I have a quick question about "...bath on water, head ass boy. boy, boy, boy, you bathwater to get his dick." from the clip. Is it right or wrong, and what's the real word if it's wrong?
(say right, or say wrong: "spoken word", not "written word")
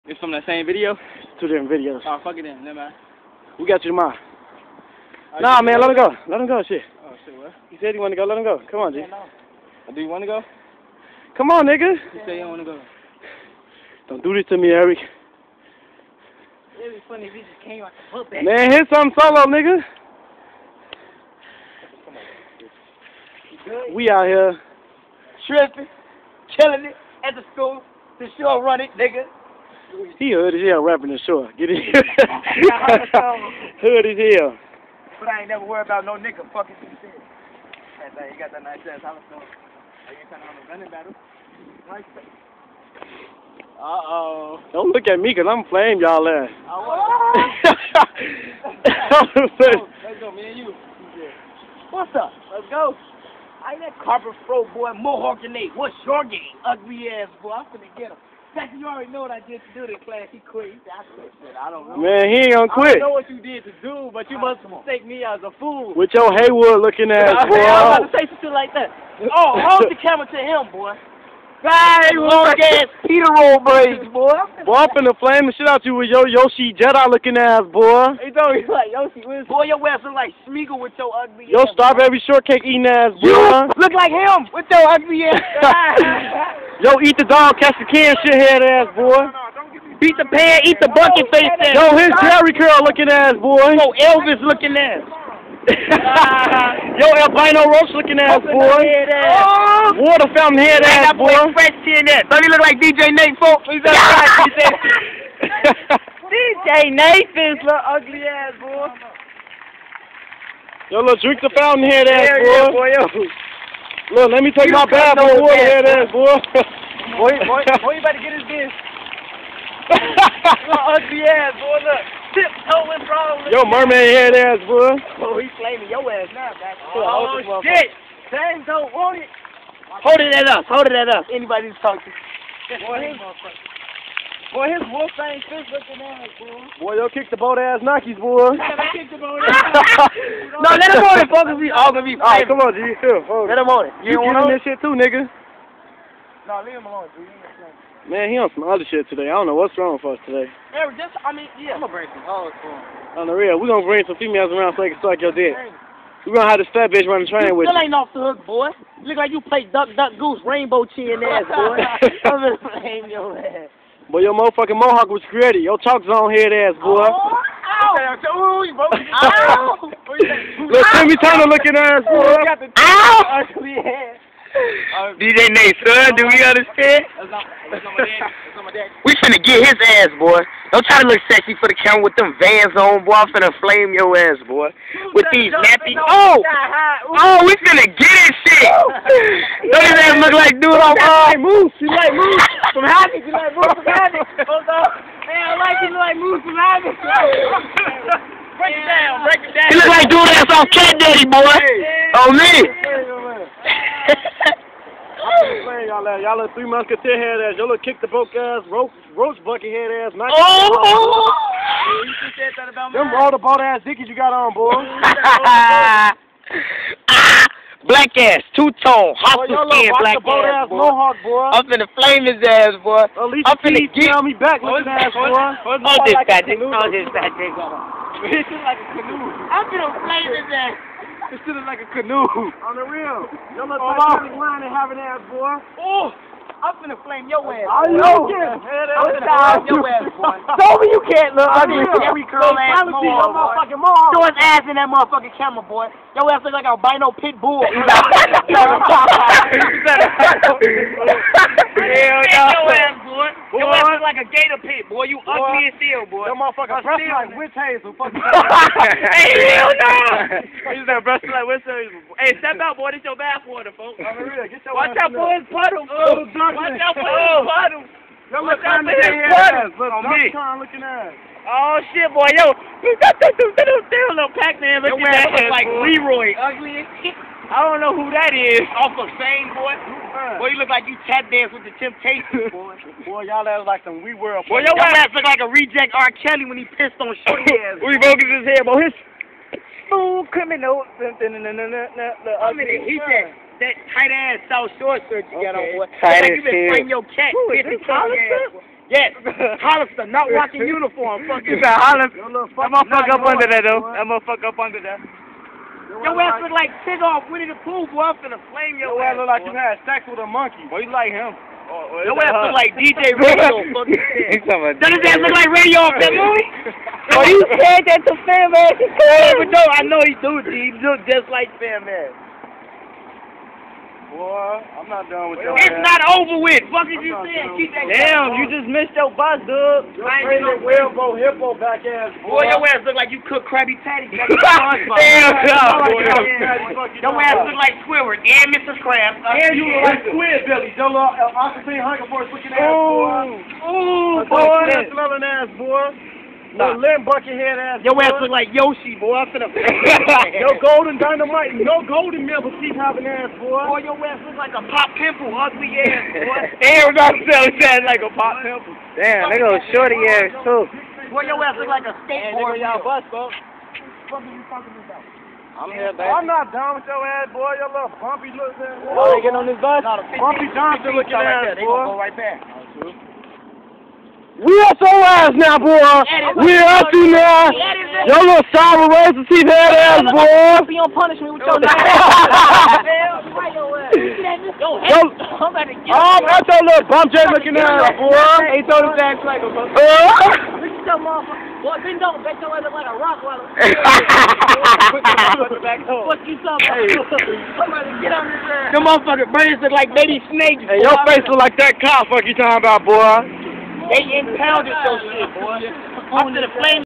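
wrong: "better", not "bathwater".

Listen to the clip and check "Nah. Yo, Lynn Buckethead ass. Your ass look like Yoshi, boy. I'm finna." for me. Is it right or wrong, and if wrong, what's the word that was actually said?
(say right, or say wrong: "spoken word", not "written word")
right.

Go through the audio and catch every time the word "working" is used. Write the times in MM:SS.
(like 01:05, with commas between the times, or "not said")
not said.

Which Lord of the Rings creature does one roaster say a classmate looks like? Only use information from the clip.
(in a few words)
Smeagol.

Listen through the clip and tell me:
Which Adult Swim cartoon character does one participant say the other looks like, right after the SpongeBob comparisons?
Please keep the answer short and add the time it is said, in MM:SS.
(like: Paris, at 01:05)
Squid Billy, at 05:40.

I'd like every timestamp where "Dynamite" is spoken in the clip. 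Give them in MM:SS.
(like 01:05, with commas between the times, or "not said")
05:50.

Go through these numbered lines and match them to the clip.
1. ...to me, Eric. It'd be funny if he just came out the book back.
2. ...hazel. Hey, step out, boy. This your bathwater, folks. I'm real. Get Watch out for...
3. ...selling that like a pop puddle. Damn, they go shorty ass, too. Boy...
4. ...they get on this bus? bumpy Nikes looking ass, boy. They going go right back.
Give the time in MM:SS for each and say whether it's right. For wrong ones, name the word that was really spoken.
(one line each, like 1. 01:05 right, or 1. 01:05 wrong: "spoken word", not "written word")
1. 00:14 right
2. 04:21 right
3. 05:57 wrong: "pimple", not "puddle"
4. 06:09 wrong: "Johnson", not "Nikes".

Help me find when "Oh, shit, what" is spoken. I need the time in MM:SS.
00:07.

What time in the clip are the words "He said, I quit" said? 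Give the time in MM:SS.
01:00.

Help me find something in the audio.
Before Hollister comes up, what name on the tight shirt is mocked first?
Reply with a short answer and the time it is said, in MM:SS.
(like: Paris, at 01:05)
South Shore, at 04:54.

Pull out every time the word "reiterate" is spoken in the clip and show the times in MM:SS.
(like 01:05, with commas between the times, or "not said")
not said.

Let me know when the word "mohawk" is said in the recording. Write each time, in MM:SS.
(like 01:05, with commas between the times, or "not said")
00:54, 02:44, 03:40.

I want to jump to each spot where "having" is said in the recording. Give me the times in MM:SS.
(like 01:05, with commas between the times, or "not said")
03:54, 05:52.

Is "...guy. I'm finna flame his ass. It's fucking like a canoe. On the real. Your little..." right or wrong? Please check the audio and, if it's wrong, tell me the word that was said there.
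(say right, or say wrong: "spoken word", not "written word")
wrong: "sitting", not "fucking".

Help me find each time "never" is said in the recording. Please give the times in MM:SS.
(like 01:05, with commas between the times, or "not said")
00:02, 00:35.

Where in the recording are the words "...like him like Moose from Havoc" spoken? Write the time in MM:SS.
03:15.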